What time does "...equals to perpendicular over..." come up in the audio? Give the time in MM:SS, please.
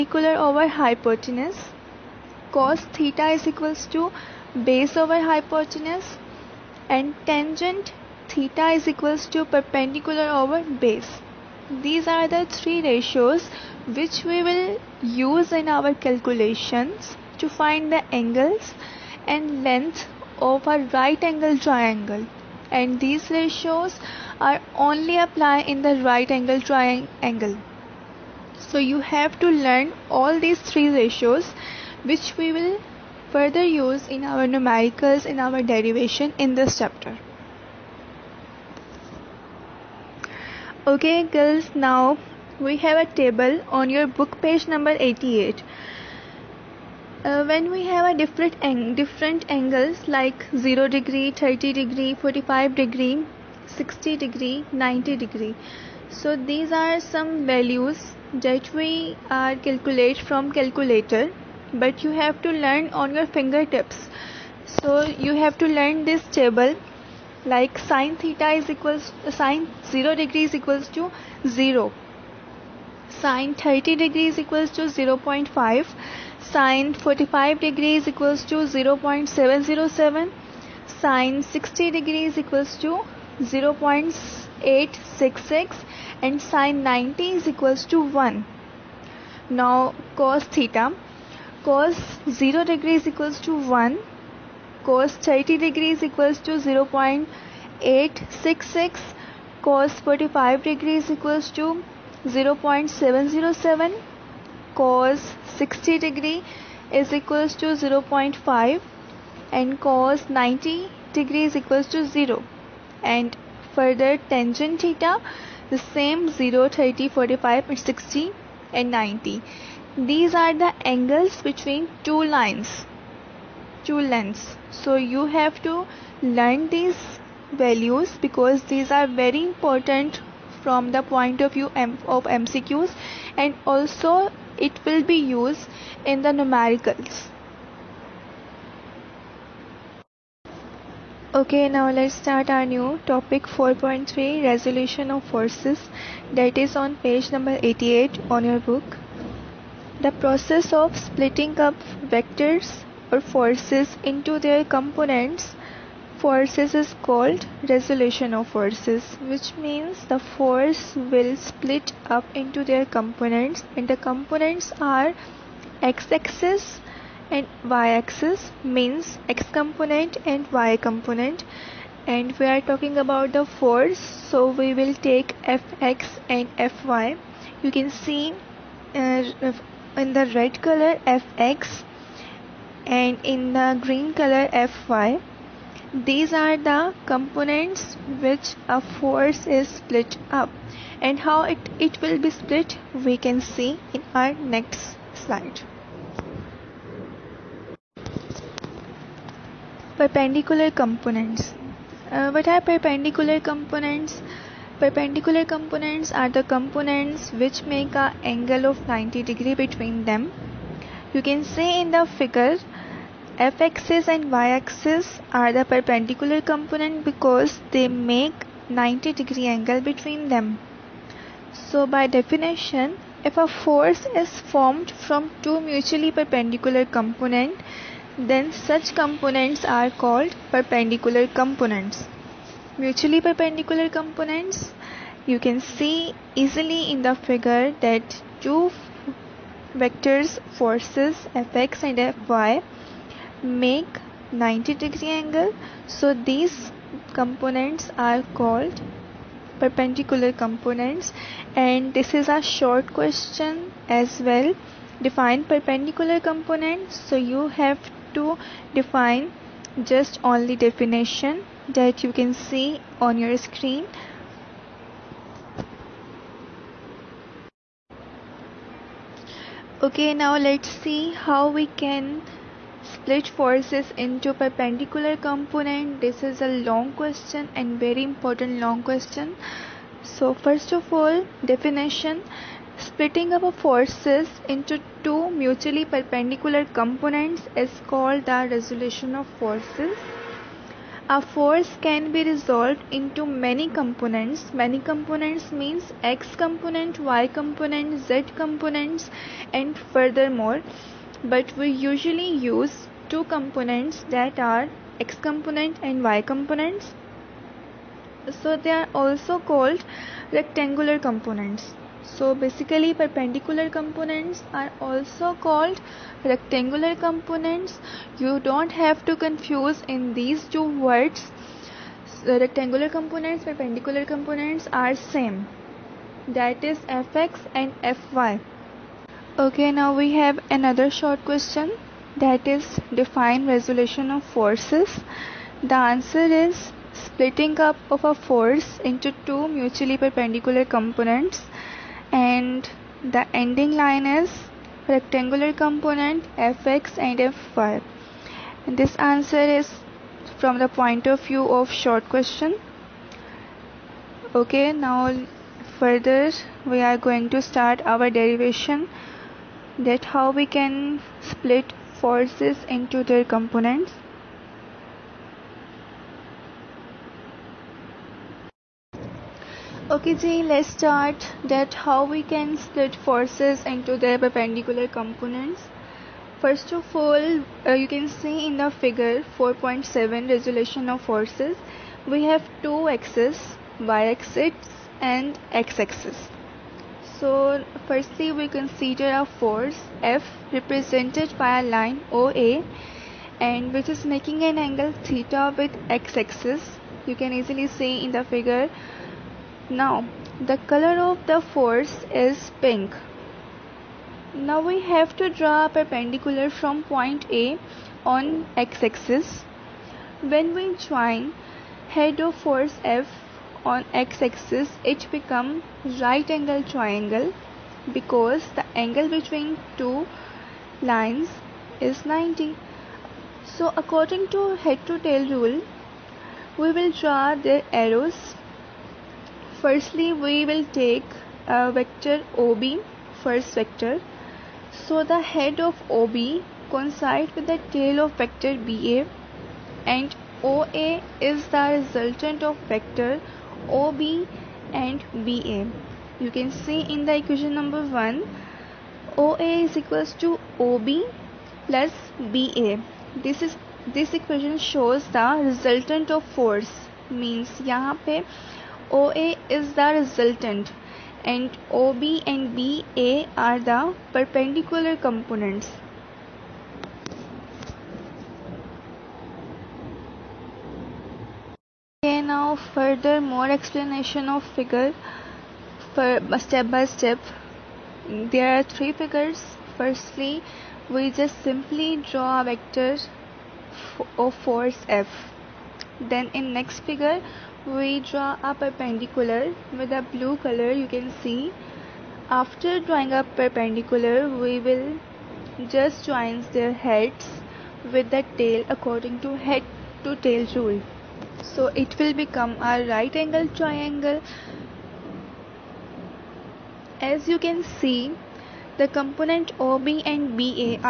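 00:08.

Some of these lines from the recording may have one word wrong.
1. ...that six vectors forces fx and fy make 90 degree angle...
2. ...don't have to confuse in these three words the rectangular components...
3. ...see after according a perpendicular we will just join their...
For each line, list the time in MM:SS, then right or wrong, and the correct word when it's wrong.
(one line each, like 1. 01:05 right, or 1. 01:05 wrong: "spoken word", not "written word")
1. 03:57 wrong: "two", not "six"
2. 05:18 wrong: "two", not "three"
3. 08:11 wrong: "drawing", not "according".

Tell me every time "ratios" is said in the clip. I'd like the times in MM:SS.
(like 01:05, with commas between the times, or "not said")
00:12, 00:23, 00:30.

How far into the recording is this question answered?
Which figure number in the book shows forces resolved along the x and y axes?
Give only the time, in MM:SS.
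06:19.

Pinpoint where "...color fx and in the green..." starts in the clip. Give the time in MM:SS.
03:00.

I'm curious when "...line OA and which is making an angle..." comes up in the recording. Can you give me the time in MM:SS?
06:31.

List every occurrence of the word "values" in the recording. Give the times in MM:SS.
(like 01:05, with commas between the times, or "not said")
00:57, 02:07.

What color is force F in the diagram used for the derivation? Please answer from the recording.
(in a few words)
Pink.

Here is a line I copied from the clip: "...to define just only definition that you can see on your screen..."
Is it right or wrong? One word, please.
right.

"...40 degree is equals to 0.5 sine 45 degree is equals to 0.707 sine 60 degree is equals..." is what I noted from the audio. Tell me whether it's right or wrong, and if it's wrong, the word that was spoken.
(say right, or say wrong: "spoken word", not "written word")
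wrong: "30", not "40".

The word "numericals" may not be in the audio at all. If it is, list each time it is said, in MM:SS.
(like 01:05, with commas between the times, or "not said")
00:34, 02:16.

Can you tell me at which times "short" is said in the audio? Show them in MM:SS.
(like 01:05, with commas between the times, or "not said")
04:12, 05:30, 05:51.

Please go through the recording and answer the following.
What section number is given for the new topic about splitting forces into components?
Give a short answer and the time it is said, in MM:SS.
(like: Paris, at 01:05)
4.3, at 02:23.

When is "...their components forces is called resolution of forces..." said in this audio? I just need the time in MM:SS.
02:34.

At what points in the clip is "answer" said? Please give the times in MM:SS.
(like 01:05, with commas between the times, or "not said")
05:35, 05:48.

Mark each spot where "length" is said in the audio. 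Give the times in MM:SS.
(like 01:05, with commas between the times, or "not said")
00:19, 02:04.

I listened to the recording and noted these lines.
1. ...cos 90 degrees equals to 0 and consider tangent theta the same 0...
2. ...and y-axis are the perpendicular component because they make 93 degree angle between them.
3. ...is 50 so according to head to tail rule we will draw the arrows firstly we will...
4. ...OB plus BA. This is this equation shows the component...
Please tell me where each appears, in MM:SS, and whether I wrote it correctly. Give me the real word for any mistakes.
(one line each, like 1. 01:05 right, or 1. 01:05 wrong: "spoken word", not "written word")
1. 01:49 wrong: "further", not "consider"
2. 03:34 wrong: "90", not "93"
3. 07:01 wrong: "90", not "50"
4. 07:30 wrong: "resultant", not "component".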